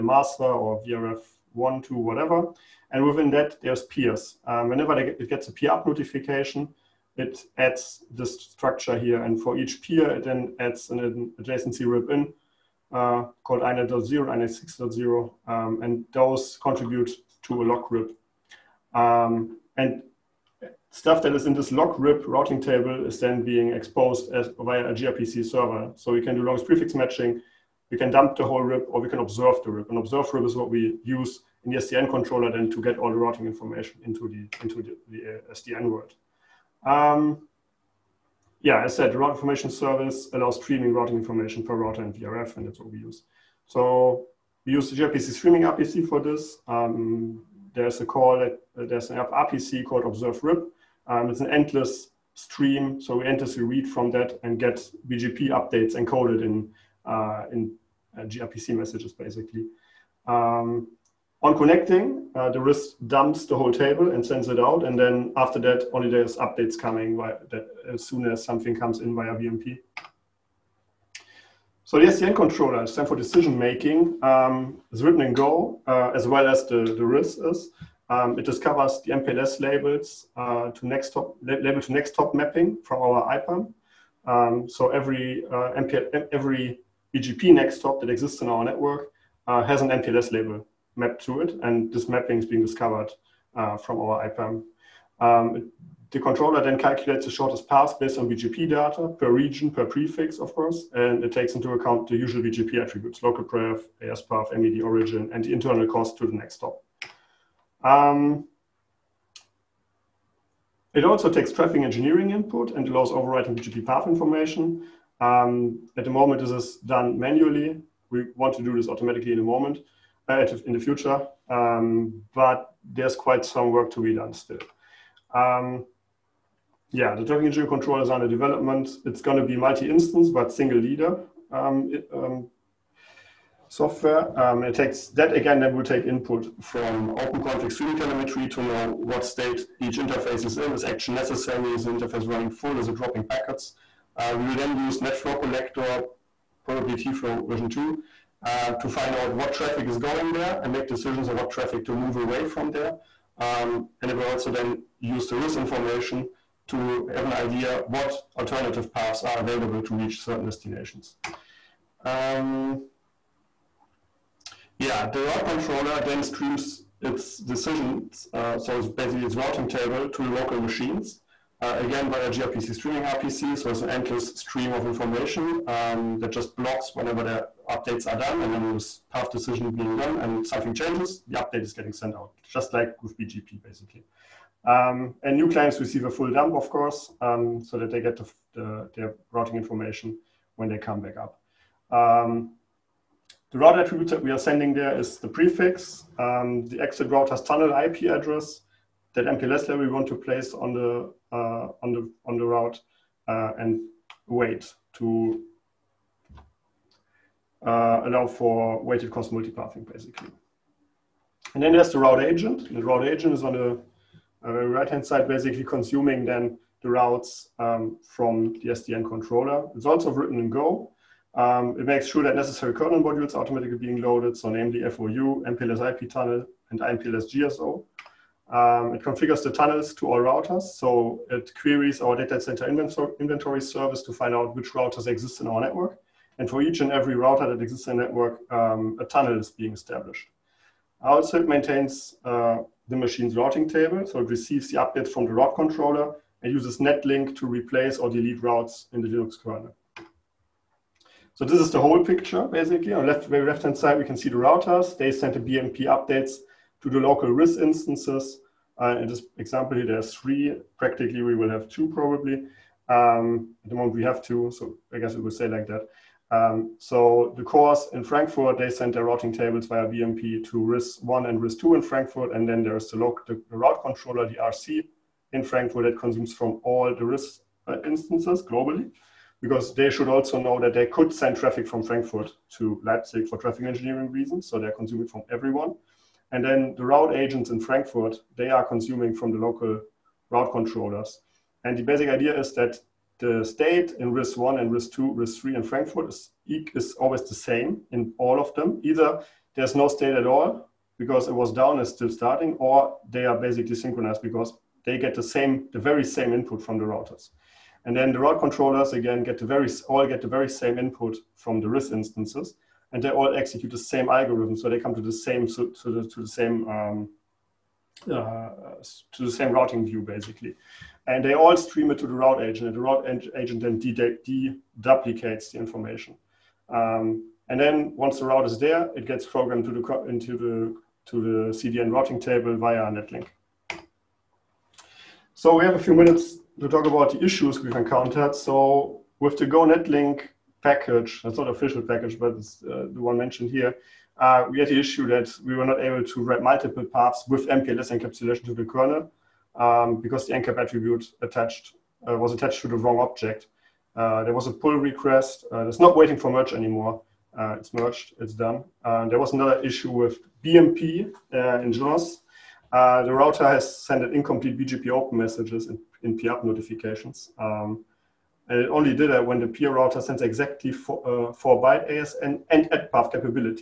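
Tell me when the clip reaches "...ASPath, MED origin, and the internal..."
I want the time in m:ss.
1:44.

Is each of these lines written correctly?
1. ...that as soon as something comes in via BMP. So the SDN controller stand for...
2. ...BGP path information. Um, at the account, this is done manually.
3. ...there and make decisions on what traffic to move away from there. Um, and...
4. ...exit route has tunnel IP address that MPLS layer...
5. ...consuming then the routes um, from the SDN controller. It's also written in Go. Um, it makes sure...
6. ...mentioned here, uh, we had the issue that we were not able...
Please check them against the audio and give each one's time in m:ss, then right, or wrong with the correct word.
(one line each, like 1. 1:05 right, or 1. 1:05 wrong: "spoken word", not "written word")
1. 1:07 right
2. 1:53 wrong: "moment", not "account"
3. 2:30 right
4. 3:16 right
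5. 3:35 right
6. 5:43 right.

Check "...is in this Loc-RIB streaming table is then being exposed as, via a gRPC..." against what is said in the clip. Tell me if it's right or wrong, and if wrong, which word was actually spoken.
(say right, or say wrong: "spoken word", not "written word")
wrong: "routing", not "streaming".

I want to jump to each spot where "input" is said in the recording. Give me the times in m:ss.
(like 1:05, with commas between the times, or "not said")
1:52, 2:16, 5:06, 5:10.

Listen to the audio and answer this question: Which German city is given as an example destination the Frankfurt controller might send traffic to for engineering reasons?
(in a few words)
Leipzig.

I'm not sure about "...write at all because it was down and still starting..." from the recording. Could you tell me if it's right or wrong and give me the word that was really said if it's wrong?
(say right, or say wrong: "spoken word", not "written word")
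wrong: "state", not "write".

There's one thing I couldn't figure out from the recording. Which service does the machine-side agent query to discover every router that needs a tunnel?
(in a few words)
data center inventory service.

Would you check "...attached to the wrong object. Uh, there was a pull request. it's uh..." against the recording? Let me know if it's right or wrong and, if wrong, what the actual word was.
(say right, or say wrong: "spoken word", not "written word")
right.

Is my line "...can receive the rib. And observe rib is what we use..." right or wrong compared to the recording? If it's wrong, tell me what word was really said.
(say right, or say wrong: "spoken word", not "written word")
wrong: "observe", not "receive".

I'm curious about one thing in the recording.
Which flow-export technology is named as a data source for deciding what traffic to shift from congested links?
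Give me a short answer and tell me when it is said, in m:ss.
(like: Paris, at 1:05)
NetFlow, at 2:24.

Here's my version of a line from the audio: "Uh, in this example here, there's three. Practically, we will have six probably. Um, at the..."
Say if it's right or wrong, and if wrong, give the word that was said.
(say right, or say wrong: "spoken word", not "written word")
wrong: "two", not "six".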